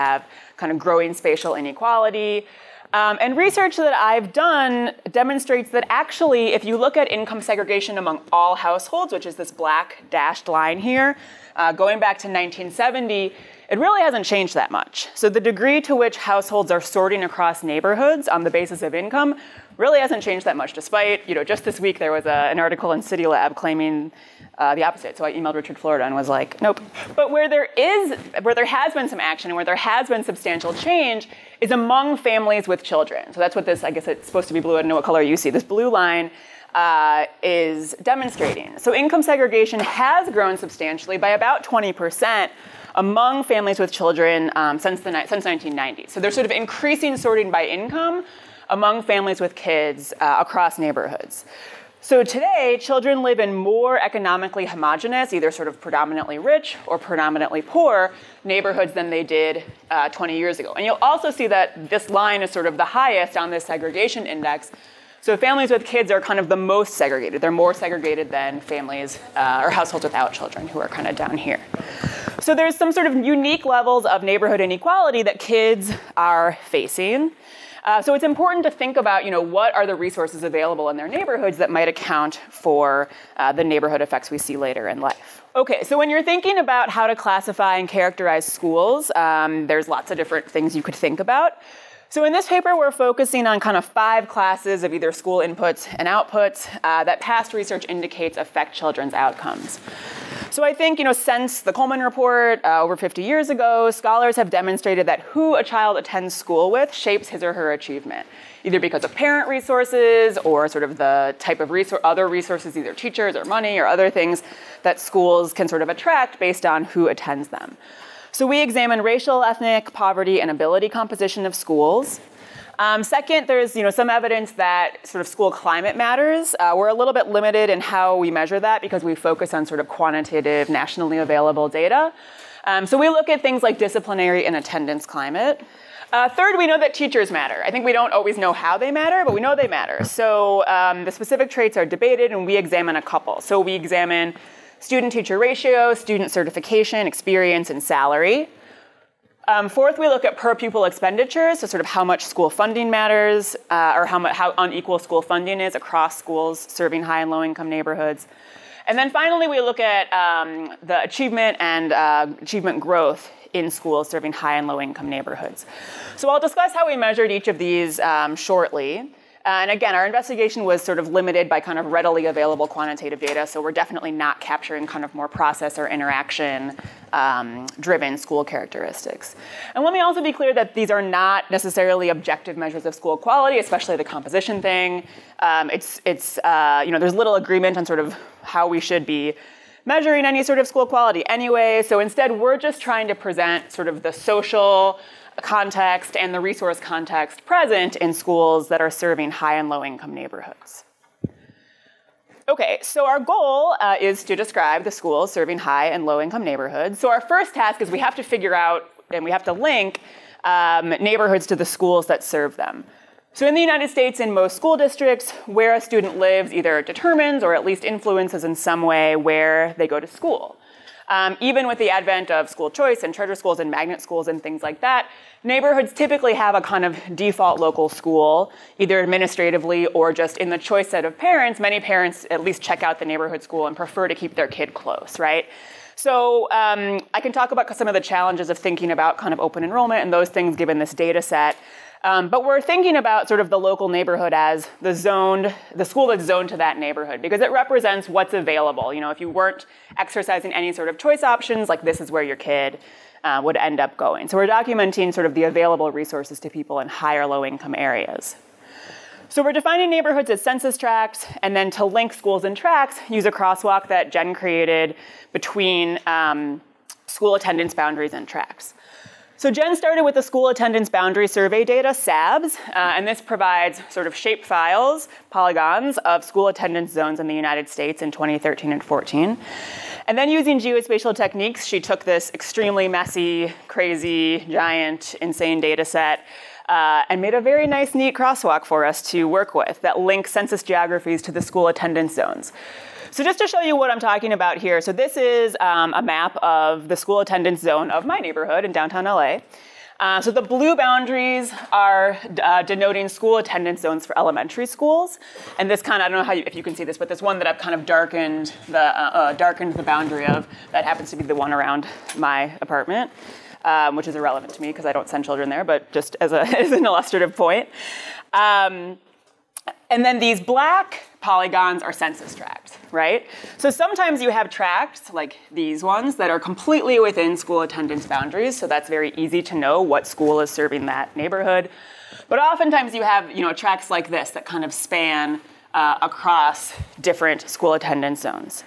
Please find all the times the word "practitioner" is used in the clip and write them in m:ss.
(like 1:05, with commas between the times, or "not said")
not said.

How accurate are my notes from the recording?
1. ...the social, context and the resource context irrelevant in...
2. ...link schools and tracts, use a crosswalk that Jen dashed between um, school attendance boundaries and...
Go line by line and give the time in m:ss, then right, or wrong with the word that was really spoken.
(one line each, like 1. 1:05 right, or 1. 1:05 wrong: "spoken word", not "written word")
1. 3:14 wrong: "present", not "irrelevant"
2. 4:21 wrong: "created", not "dashed".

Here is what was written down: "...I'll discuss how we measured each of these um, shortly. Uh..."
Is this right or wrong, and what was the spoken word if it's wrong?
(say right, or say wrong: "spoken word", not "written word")
right.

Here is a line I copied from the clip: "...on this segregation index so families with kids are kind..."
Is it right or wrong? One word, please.
right.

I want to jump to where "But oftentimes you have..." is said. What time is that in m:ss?
5:32.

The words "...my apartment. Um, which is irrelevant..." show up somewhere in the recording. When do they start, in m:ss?
5:12.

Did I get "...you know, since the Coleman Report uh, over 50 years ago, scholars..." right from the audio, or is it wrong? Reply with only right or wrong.
right.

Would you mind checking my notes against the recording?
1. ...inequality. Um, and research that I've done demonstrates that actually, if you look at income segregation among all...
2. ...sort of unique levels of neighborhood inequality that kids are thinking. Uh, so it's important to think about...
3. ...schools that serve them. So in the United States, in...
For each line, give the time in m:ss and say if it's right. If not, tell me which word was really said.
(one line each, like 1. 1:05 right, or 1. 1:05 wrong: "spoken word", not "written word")
1. 0:01 right
2. 1:12 wrong: "facing", not "thinking"
3. 3:31 right.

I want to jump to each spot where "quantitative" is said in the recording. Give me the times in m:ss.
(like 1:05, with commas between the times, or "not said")
2:09, 2:52.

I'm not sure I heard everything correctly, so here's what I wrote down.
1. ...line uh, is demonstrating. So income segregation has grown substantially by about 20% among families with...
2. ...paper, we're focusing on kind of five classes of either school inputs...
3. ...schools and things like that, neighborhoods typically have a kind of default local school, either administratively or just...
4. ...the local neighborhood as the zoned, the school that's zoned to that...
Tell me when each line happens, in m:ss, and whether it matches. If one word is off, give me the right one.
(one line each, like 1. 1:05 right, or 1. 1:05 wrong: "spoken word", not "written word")
1. 0:35 right
2. 1:32 right
3. 3:44 right
4. 4:03 right.